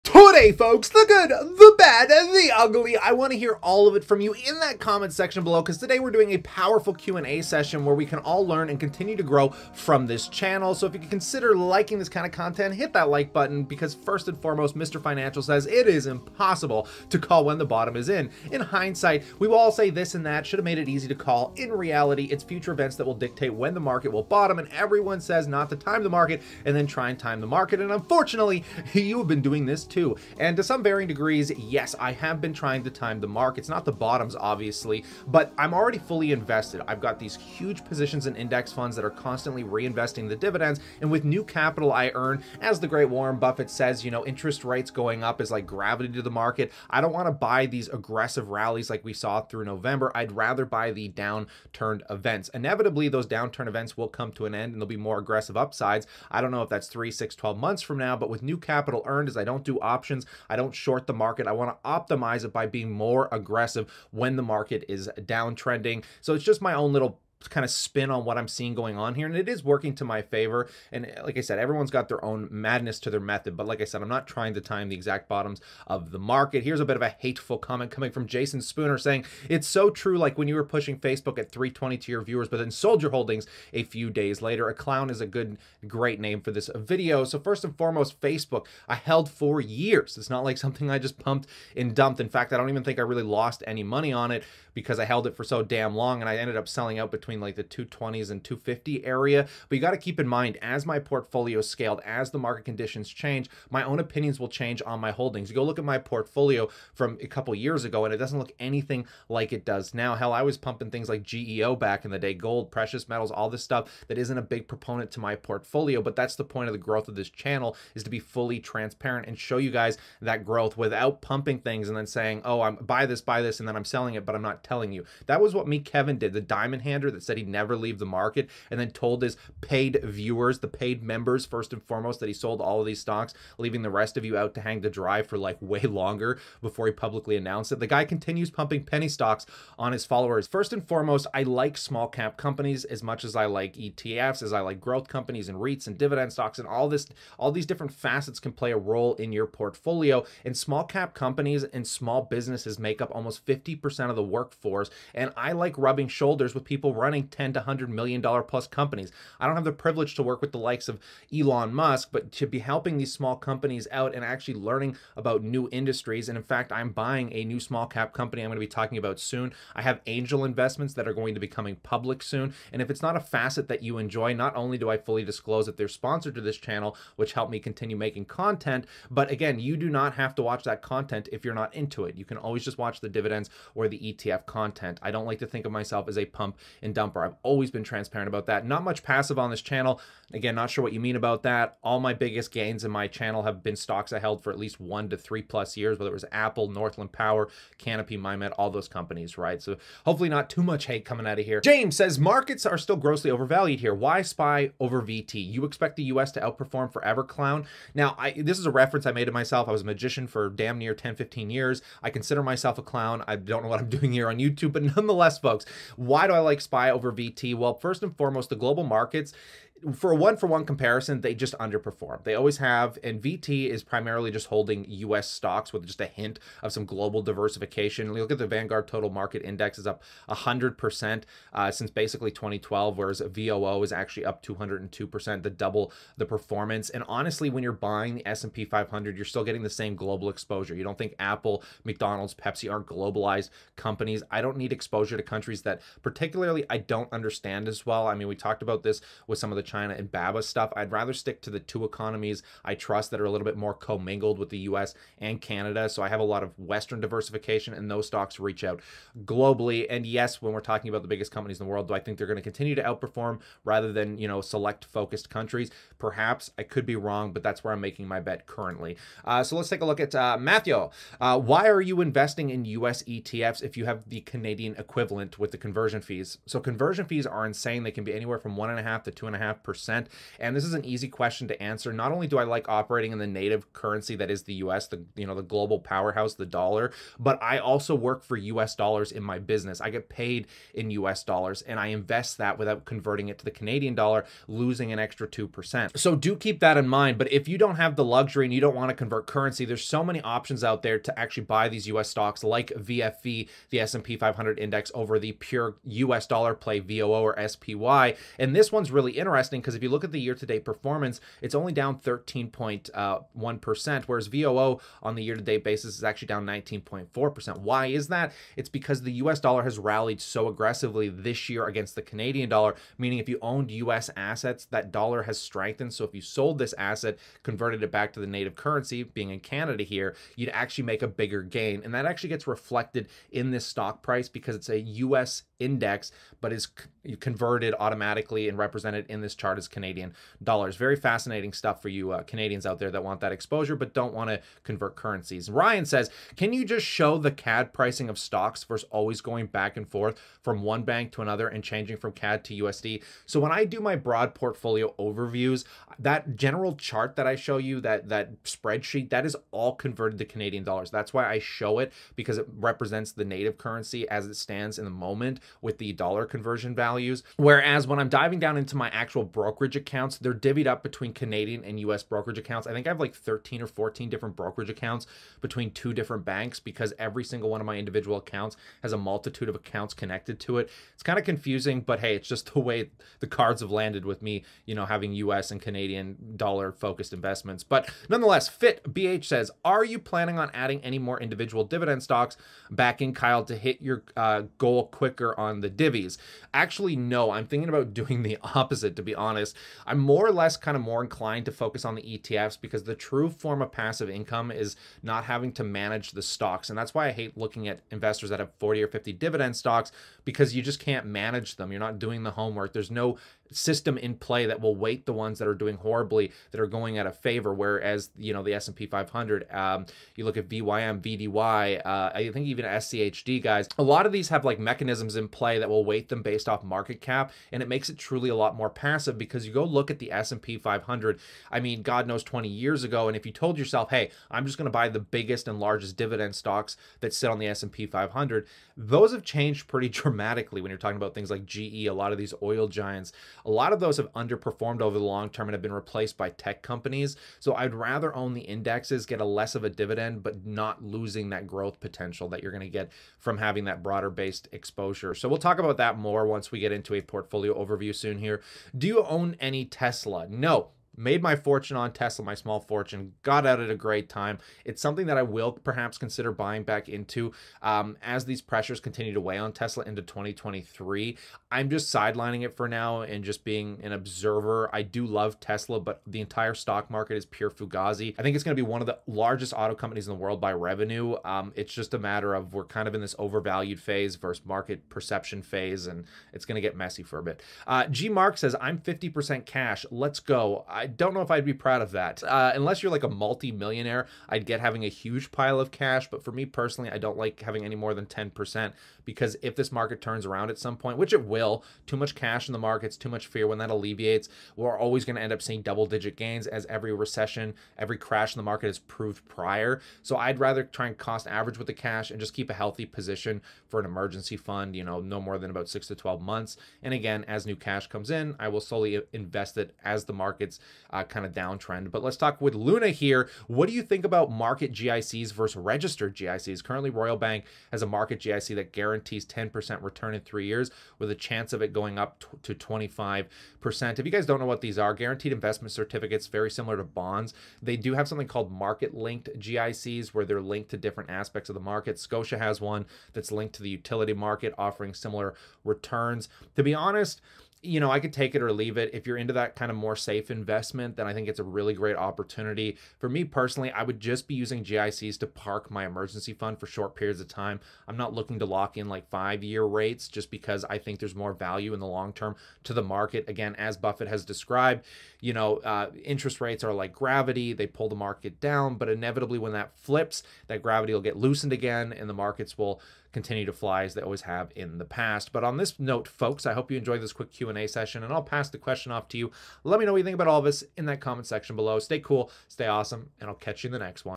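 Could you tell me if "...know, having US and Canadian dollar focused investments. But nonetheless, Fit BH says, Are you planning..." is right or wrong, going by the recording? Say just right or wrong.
right.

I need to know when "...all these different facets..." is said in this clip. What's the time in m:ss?
2:27.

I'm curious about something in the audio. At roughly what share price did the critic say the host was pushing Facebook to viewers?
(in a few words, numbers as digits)
320.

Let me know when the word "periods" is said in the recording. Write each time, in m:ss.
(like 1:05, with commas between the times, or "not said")
9:16.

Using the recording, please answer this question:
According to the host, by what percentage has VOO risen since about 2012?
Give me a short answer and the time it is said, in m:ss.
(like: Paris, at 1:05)
202%, at 3:54.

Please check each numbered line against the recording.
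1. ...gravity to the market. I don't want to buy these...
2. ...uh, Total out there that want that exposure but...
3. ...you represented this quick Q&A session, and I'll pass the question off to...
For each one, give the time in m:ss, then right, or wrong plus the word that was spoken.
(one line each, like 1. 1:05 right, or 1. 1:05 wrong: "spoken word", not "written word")
1. 0:45 right
2. 5:42 wrong: "Canadians", not "Total"
3. 9:36 wrong: "enjoyed", not "represented".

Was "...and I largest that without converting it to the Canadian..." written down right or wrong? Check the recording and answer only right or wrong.
wrong.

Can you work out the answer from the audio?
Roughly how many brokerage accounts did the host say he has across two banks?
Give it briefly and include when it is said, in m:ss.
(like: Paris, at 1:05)
13 or 14, at 6:13.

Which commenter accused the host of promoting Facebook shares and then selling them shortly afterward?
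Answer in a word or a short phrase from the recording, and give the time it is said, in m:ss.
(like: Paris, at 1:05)
Jason Spooner, at 1:18.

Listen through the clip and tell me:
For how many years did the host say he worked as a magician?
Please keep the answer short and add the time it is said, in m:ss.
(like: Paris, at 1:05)
10 to 15, at 3:30.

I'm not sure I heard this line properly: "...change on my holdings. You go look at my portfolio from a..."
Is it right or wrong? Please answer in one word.
right.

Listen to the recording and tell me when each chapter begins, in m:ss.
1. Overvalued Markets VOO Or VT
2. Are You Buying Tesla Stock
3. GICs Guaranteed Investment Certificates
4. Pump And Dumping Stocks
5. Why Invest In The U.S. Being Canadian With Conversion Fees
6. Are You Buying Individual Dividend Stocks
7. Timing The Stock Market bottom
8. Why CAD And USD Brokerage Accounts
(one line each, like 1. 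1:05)
1. 3:20
2. 7:38
3. 8:42
4. 1:20
5. 4:30
6. 6:28
7. 0:15
8. 5:45.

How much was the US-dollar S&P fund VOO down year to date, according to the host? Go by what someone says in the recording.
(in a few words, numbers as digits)
19.4%.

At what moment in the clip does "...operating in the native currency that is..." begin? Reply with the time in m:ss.
4:42.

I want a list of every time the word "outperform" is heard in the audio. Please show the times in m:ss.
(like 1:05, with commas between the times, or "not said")
3:26, 4:22.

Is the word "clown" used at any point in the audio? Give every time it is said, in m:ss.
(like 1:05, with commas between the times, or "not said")
1:24, 3:27, 3:32.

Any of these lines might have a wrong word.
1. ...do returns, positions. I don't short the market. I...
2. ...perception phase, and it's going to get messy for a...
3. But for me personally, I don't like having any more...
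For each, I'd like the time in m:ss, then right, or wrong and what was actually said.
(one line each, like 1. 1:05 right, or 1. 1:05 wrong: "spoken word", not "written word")
1. 0:59 wrong: "options", not "returns"
2. 8:04 right
3. 8:16 right.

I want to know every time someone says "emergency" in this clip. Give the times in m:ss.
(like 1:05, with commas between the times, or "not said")
8:33, 9:15.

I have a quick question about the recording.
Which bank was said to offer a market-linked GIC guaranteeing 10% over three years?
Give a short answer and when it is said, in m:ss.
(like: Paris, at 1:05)
Royal Bank, at 8:46.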